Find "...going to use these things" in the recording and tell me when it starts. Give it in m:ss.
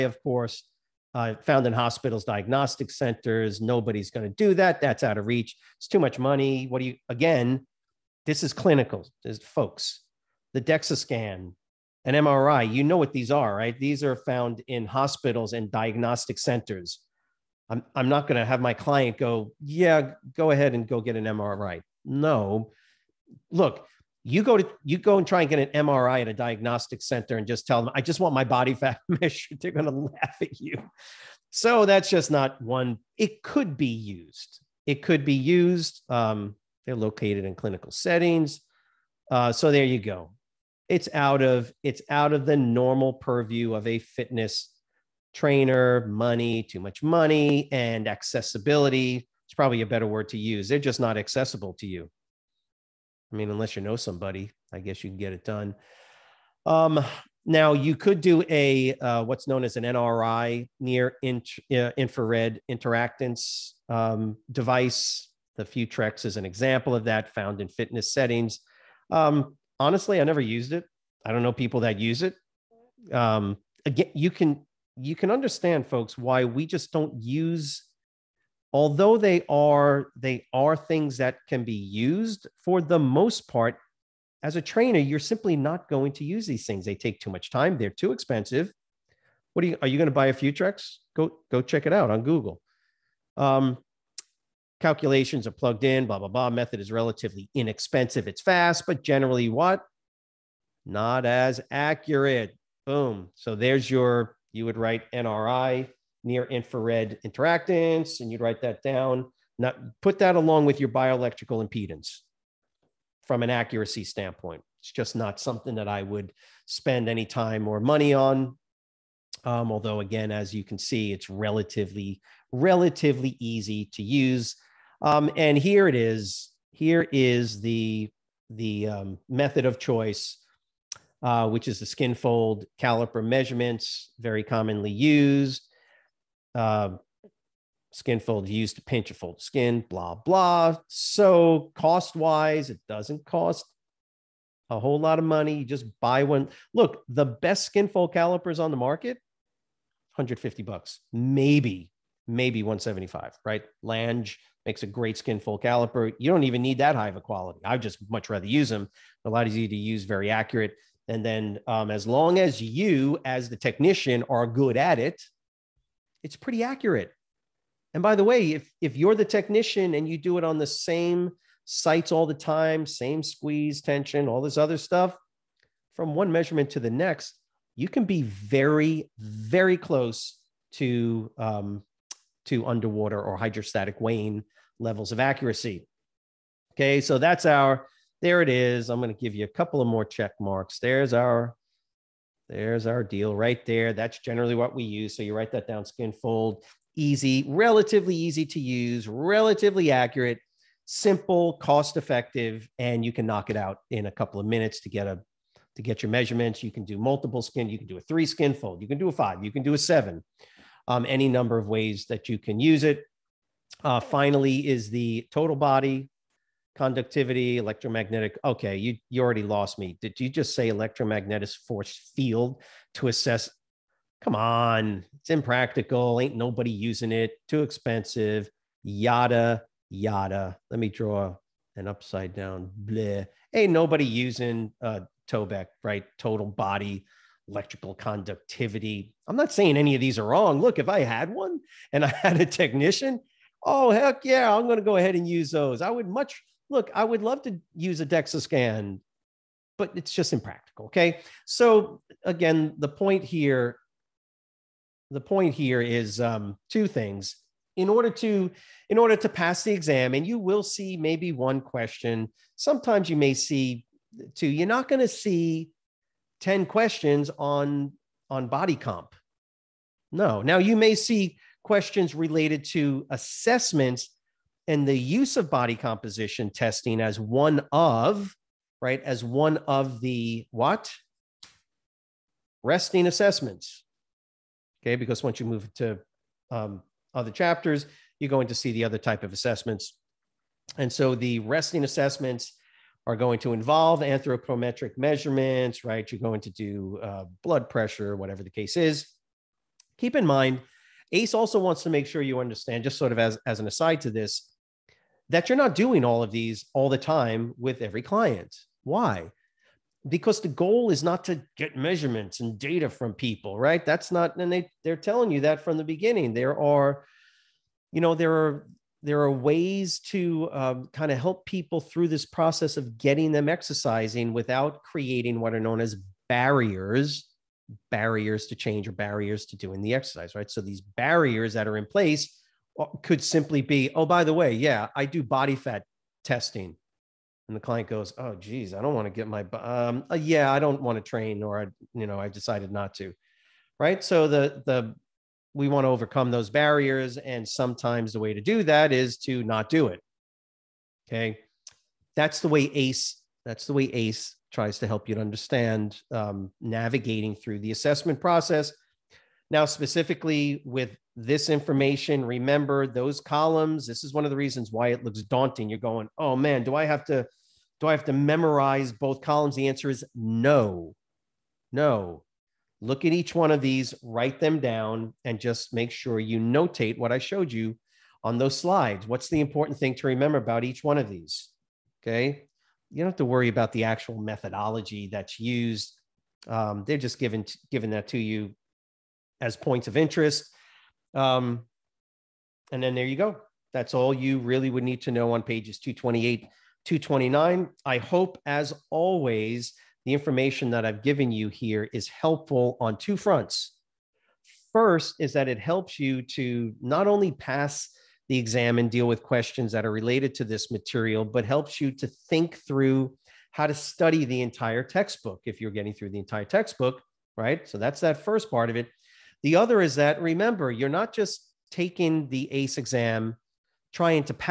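1:25.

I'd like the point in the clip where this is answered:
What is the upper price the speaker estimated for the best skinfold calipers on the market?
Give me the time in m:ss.
2:32.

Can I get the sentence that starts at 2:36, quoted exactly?
You don't even need that high of a quality.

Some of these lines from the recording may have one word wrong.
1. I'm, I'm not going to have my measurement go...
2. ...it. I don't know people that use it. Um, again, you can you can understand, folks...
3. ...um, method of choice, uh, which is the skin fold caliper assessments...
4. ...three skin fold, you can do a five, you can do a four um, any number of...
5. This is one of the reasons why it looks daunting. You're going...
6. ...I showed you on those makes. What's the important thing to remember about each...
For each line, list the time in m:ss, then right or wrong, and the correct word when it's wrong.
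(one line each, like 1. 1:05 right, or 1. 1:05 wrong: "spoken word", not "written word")
1. 0:17 wrong: "client", not "measurement"
2. 1:10 right
3. 2:08 wrong: "measurements", not "assessments"
4. 3:28 wrong: "seven", not "four"
5. 6:03 right
6. 6:17 wrong: "slides", not "makes".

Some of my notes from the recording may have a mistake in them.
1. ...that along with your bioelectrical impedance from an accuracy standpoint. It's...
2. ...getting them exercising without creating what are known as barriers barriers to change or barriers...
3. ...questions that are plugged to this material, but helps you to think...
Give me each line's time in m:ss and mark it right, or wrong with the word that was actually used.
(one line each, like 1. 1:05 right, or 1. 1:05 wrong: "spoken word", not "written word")
1. 1:50 right
2. 5:22 right
3. 6:49 wrong: "related", not "plugged".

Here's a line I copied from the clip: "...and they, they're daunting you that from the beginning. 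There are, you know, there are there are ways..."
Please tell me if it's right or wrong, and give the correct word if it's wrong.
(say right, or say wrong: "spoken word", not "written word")
wrong: "telling", not "daunting".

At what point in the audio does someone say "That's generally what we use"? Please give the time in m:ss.
3:13.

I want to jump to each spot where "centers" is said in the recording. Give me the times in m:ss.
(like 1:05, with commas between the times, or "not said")
0:02, 0:16, 0:27.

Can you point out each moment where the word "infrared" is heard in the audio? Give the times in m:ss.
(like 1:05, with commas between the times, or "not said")
1:01, 1:46.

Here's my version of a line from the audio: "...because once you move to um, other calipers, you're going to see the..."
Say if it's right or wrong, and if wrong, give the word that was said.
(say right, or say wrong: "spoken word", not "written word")
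wrong: "chapters", not "calipers".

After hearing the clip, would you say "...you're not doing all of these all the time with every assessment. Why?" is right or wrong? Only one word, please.
wrong.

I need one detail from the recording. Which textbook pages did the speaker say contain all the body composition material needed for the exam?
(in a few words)
228, 229.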